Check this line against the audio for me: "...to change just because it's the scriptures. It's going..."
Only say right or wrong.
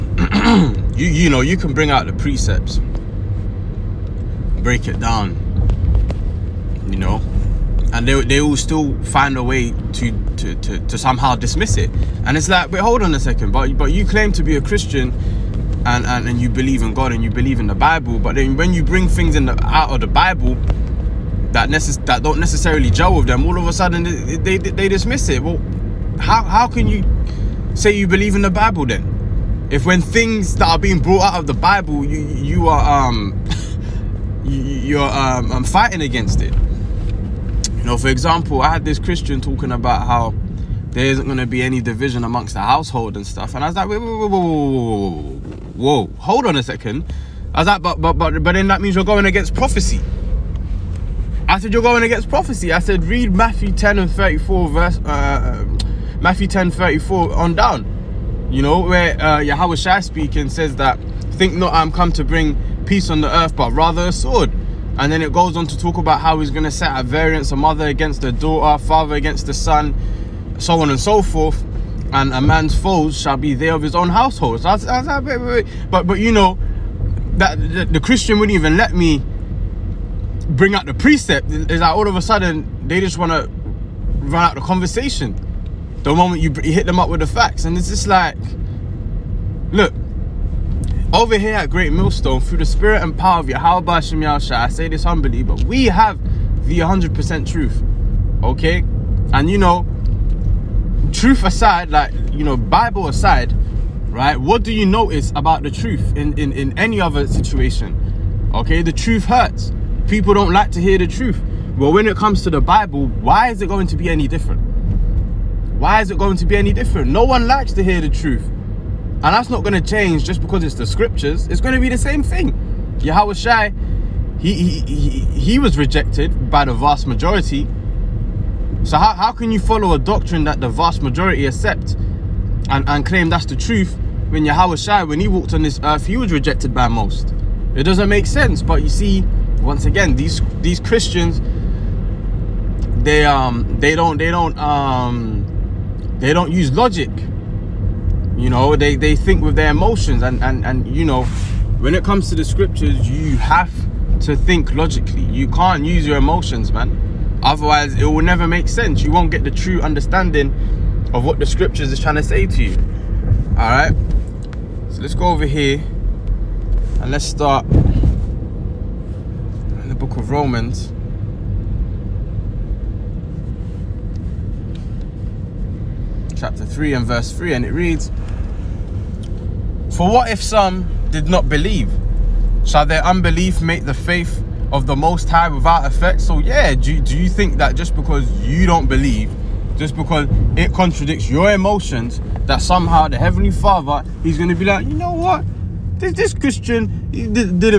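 right.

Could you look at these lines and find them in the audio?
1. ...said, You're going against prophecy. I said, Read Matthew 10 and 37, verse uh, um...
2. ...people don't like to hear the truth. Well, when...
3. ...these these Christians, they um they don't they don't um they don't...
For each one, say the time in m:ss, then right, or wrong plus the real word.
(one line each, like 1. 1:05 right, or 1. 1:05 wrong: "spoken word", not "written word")
1. 0:51 wrong: "34", not "37"
2. 1:50 right
3. 2:20 right.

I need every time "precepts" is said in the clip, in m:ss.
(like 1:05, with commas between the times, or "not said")
0:02, 1:20.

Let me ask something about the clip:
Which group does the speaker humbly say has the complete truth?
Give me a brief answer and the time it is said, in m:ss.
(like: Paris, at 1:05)
Great Millstone, at 1:31.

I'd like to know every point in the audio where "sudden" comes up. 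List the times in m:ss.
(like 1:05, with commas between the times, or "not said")
0:23, 1:22.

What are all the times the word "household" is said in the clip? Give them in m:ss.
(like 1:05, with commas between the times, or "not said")
0:42, 1:14.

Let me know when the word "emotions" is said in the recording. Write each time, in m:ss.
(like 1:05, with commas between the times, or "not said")
2:29, 2:36, 3:11.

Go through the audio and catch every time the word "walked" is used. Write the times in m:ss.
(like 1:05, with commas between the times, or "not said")
2:15.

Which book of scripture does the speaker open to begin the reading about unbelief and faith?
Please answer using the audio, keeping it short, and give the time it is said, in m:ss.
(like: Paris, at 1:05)
Romans, at 2:50.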